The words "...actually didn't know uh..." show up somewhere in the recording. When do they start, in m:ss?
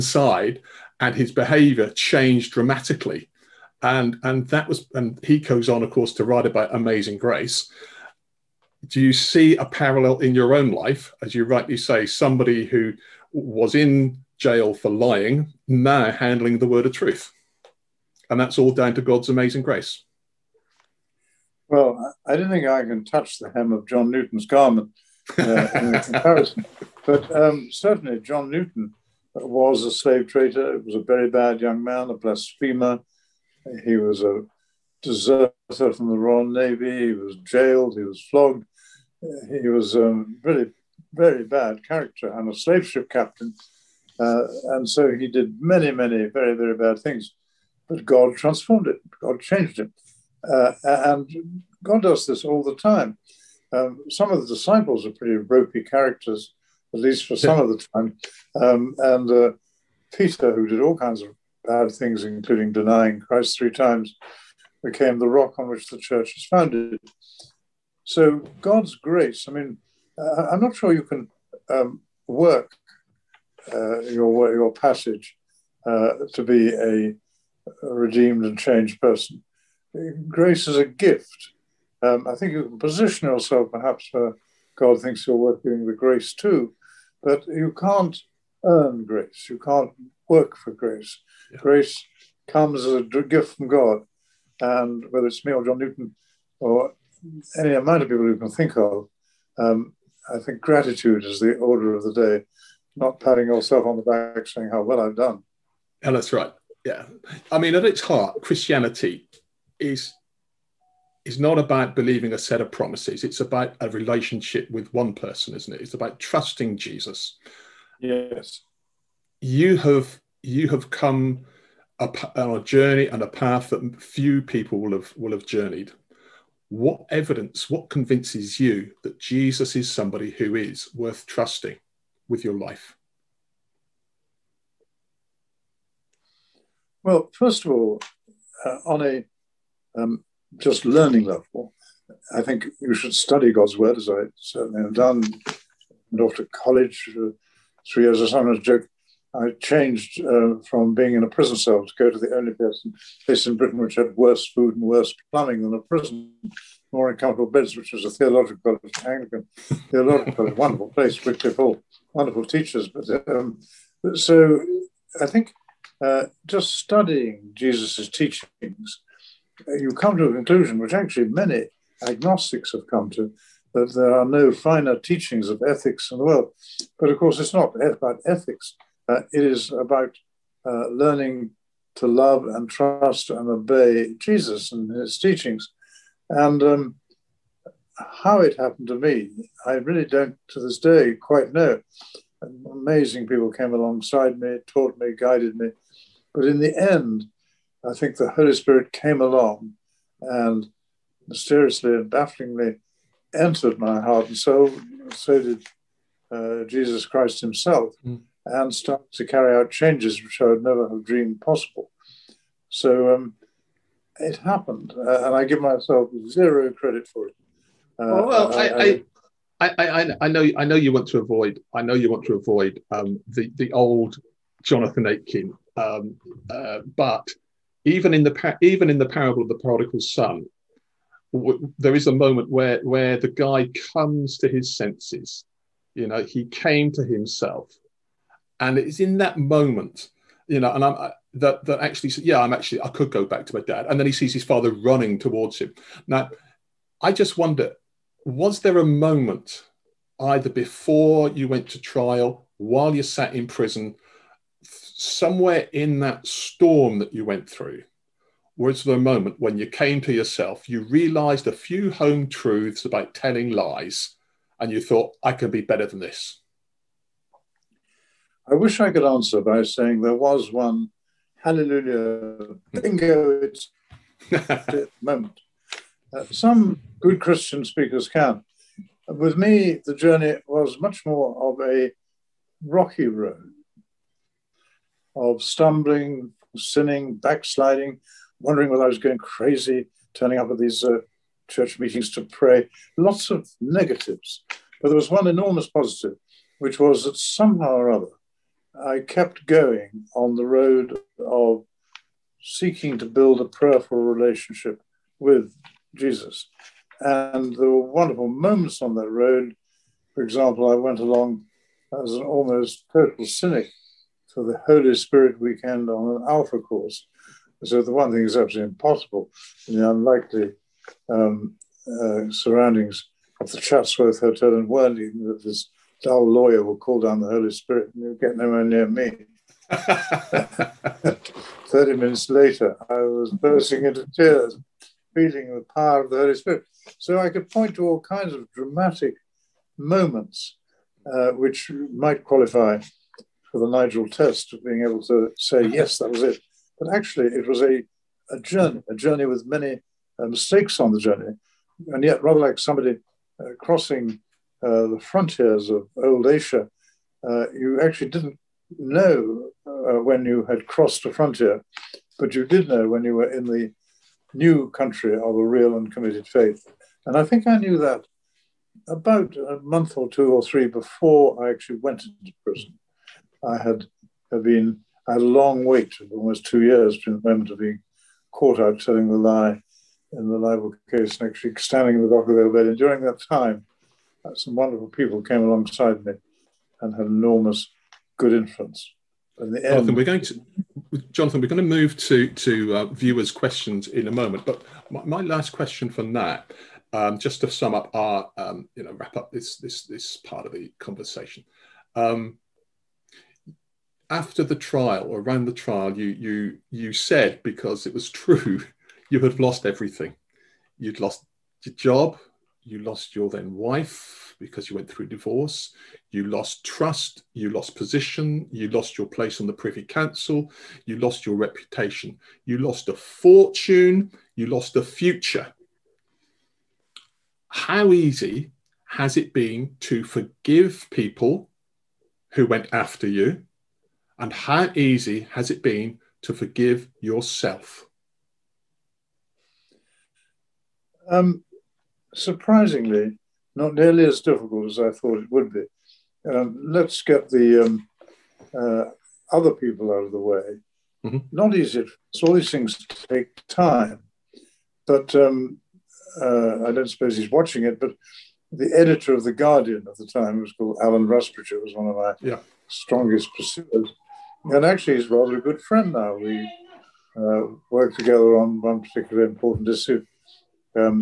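5:57.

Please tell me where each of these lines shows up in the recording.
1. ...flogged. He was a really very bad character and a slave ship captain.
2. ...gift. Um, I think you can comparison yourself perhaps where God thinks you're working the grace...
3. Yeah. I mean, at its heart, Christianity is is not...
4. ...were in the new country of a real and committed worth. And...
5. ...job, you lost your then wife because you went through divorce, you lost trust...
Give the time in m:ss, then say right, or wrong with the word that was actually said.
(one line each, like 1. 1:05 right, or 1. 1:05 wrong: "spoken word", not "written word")
1. 0:38 right
2. 1:20 wrong: "position", not "comparison"
3. 1:46 right
4. 6:03 wrong: "faith", not "worth"
5. 6:51 right.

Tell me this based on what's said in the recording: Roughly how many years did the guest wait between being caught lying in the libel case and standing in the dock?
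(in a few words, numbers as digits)
2.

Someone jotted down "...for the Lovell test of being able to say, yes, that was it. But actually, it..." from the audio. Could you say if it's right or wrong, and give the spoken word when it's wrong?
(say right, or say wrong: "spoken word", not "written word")
wrong: "Nigel", not "Lovell".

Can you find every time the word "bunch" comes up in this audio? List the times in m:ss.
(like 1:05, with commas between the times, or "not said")
not said.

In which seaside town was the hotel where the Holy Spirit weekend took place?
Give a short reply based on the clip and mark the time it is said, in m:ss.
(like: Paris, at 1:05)
Worthing, at 5:24.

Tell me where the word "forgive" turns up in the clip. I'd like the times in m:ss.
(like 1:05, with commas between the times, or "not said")
7:10, 7:16.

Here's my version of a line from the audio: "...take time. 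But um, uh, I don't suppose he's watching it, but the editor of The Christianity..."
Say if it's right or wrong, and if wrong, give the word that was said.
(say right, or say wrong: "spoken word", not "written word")
wrong: "Guardian", not "Christianity".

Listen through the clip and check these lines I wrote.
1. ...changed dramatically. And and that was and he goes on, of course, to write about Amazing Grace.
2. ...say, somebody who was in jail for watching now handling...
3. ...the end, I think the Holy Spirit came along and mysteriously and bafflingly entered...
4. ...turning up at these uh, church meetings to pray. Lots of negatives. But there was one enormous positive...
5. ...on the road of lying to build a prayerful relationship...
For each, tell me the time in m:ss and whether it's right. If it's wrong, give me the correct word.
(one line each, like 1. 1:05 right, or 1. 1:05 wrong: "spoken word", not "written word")
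1. 0:01 right
2. 0:11 wrong: "lying", not "watching"
3. 3:16 right
4. 4:50 right
5. 5:00 wrong: "seeking", not "lying".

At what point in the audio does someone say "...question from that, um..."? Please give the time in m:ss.
6:35.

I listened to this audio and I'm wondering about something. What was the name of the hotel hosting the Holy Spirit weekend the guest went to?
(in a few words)
Chatsworth Hotel.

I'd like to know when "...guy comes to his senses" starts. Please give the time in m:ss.
3:53.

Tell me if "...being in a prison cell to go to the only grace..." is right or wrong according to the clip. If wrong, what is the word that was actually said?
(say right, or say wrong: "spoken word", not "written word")
wrong: "place", not "grace".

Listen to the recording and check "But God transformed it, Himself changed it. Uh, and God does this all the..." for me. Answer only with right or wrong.
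wrong.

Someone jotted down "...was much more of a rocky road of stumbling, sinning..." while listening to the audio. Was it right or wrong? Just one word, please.
right.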